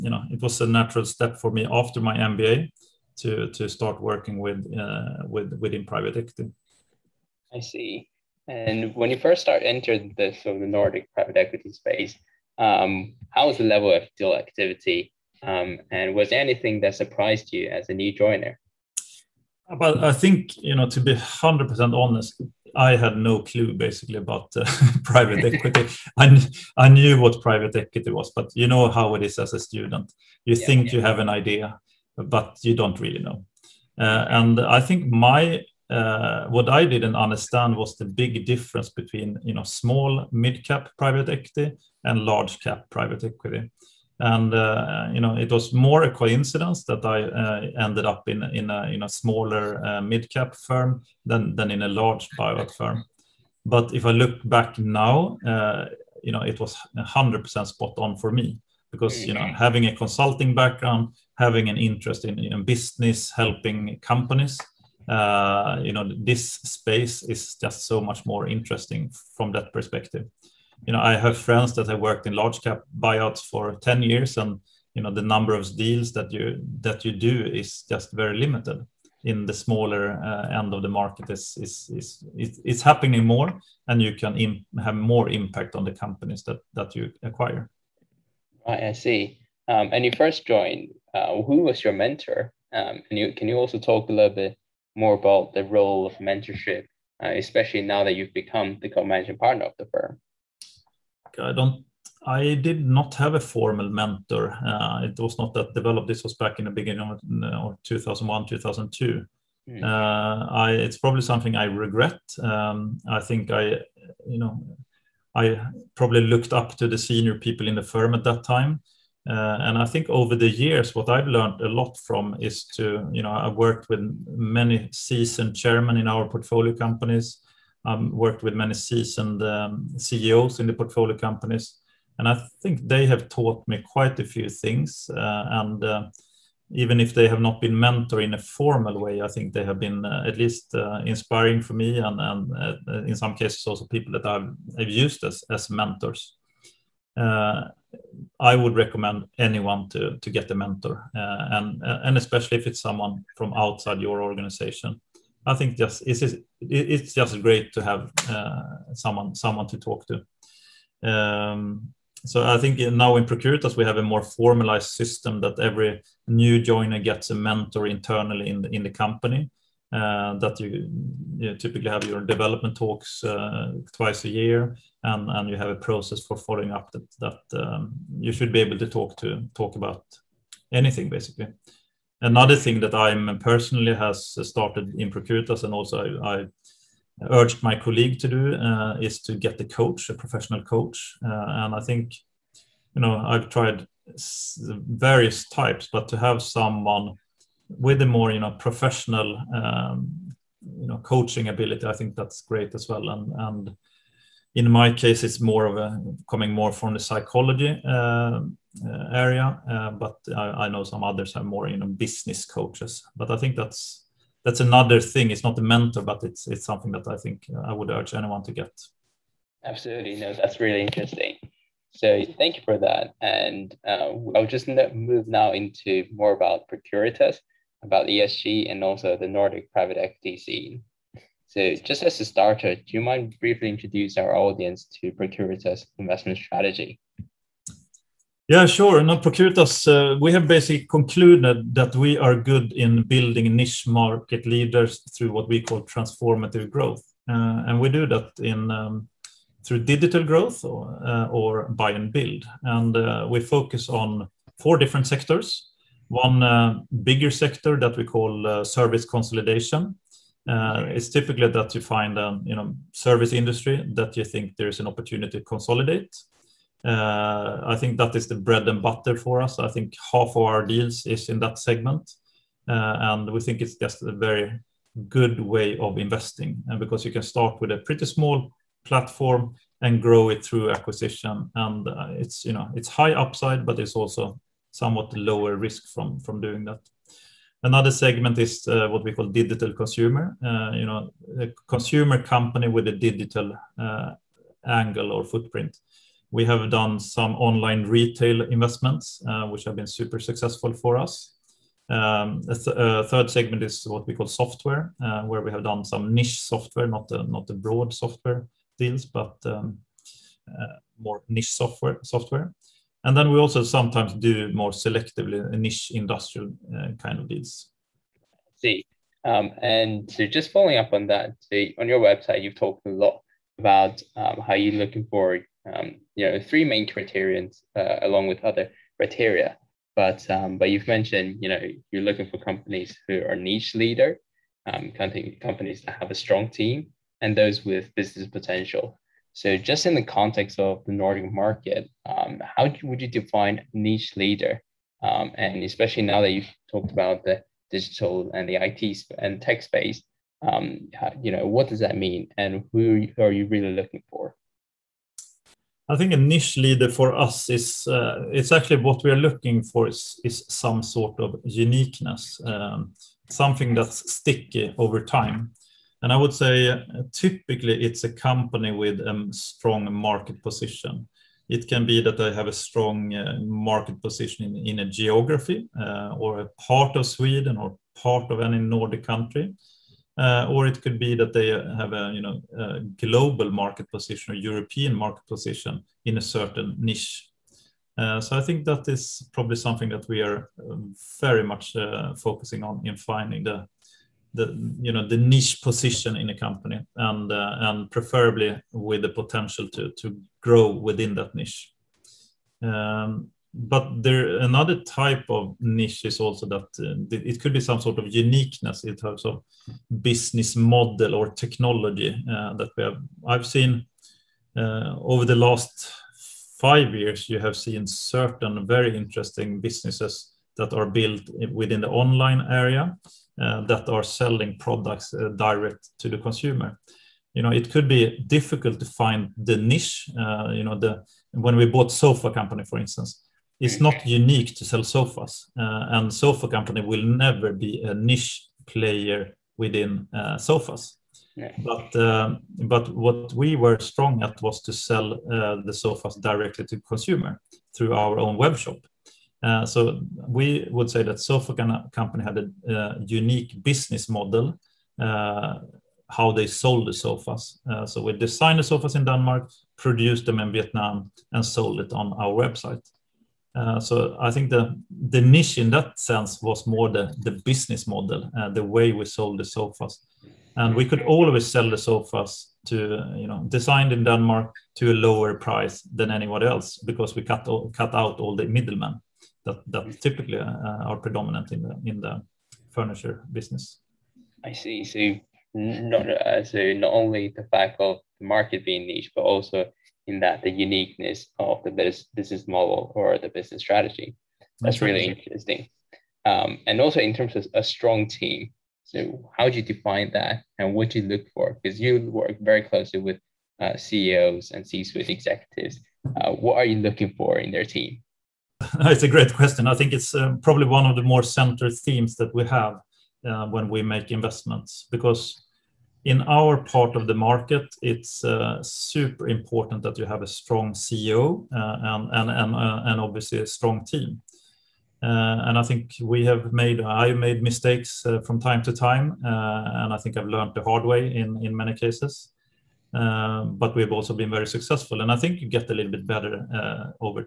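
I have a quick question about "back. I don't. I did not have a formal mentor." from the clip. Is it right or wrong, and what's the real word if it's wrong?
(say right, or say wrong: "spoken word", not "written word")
right.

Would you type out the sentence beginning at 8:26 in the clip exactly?
Uh, what are you looking for in their team?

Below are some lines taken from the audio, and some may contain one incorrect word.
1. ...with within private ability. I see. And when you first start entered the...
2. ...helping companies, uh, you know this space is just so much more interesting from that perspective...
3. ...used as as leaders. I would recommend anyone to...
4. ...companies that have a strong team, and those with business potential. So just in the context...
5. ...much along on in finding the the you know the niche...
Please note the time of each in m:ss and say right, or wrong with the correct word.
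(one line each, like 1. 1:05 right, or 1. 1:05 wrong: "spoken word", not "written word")
1. 0:05 wrong: "equity", not "ability"
2. 1:03 right
3. 2:24 wrong: "mentors", not "leaders"
4. 5:35 right
5. 6:31 wrong: "focusing", not "along".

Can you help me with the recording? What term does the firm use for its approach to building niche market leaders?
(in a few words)
Transformative growth.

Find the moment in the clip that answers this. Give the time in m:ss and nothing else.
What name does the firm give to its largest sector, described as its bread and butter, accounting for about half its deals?
4:18.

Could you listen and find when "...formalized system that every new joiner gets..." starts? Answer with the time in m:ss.
2:44.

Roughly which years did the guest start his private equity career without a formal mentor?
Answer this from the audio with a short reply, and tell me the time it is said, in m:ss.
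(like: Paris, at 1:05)
2001, 2002, at 1:47.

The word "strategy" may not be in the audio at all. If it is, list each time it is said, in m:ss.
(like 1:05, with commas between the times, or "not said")
3:56, 8:13.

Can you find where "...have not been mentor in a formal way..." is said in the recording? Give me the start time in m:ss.
2:17.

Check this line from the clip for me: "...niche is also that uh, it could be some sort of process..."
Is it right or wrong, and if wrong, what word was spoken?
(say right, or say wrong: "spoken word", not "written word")
wrong: "uniqueness", not "process".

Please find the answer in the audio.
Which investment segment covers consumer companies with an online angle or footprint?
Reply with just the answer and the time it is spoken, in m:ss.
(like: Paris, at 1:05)
Digital consumer, at 4:49.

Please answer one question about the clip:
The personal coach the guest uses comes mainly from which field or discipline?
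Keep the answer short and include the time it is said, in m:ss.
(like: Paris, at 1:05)
Psychology, at 3:26.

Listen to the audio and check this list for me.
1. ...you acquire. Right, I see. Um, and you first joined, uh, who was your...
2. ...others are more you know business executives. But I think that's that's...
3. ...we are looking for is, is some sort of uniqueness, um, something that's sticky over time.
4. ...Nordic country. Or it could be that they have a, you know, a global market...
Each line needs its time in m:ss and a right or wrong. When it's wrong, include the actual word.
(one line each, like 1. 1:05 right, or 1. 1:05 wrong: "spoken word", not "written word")
1. 1:26 right
2. 3:31 wrong: "coaches", not "executives"
3. 5:59 right
4. 6:18 right.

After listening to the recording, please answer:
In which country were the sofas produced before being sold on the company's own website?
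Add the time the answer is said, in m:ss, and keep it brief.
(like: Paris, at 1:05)
Vietnam, at 7:40.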